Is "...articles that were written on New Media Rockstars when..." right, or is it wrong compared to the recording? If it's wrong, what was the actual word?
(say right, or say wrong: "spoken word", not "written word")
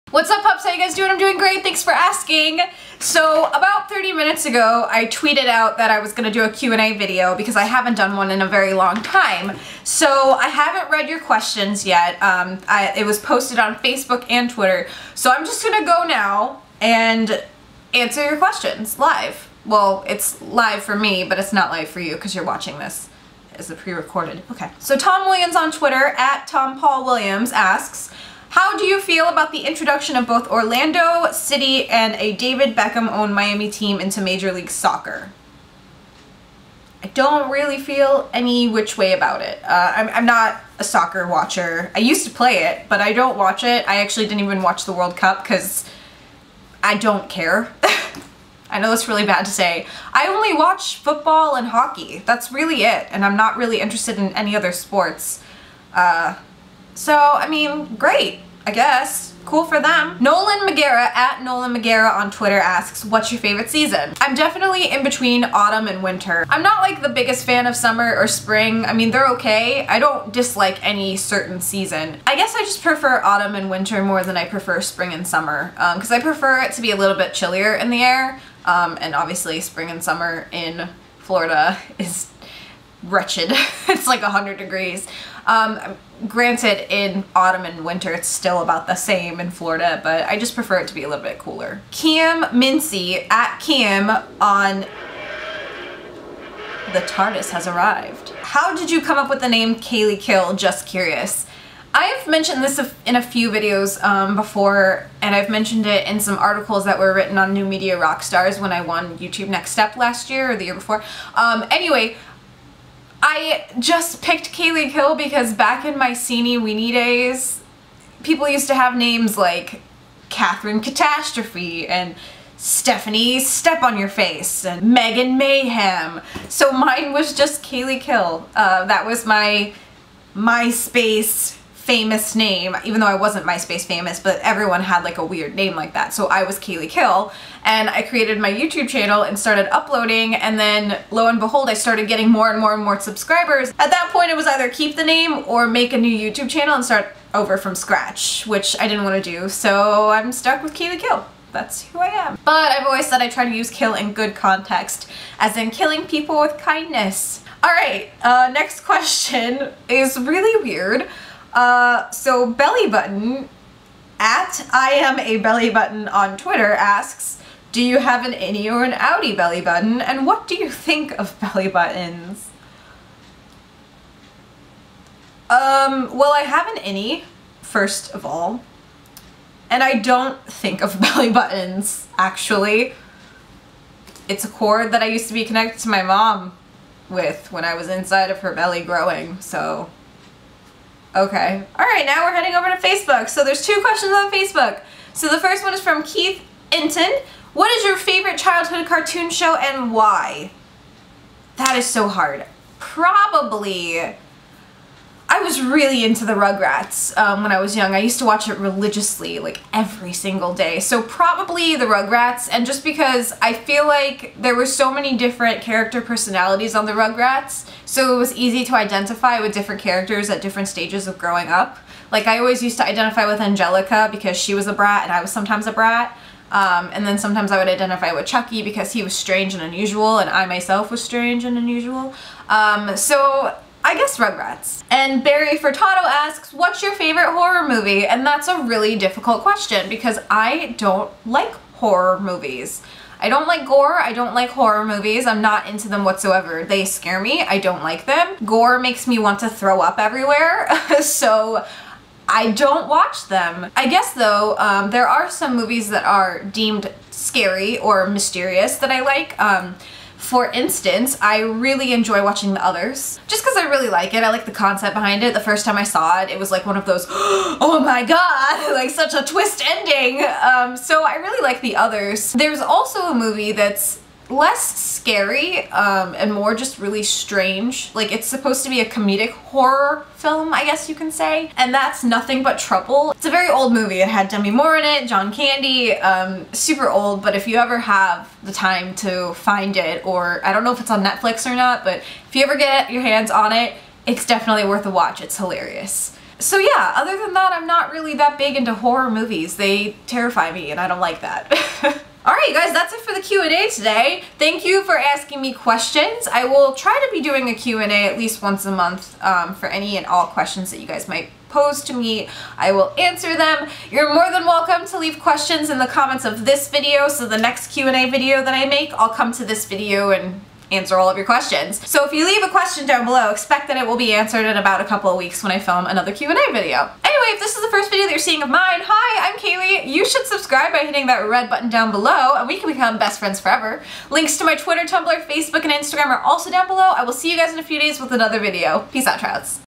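right.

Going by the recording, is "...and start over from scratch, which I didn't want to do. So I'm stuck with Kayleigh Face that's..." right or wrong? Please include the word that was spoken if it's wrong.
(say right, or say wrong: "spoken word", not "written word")
wrong: "Kill", not "Face".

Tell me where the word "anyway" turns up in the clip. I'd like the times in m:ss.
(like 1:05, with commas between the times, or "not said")
1:51, 5:27.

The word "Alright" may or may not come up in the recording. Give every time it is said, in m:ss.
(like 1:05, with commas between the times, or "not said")
2:37, 5:02.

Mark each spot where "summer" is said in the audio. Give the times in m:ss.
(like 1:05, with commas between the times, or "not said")
1:07, 1:15, 1:20.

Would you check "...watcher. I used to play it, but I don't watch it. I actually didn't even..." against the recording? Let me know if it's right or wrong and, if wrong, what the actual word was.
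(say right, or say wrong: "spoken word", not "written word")
right.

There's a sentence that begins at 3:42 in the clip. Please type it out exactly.
Like I always used to identify with Angelica because she was a brat and I was sometimes a brat.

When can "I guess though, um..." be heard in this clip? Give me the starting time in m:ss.
4:13.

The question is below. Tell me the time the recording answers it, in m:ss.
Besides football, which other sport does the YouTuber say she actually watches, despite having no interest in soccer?
0:51.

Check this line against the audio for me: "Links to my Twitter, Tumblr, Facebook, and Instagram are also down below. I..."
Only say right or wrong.
right.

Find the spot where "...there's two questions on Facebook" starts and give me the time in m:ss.
3:13.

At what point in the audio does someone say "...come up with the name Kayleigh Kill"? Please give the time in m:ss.
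1:39.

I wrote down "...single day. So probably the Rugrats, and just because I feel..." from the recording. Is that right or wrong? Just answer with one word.
right.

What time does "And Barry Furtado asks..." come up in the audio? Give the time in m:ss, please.
3:54.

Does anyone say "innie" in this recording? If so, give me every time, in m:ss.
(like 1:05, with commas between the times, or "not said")
2:48, 2:56.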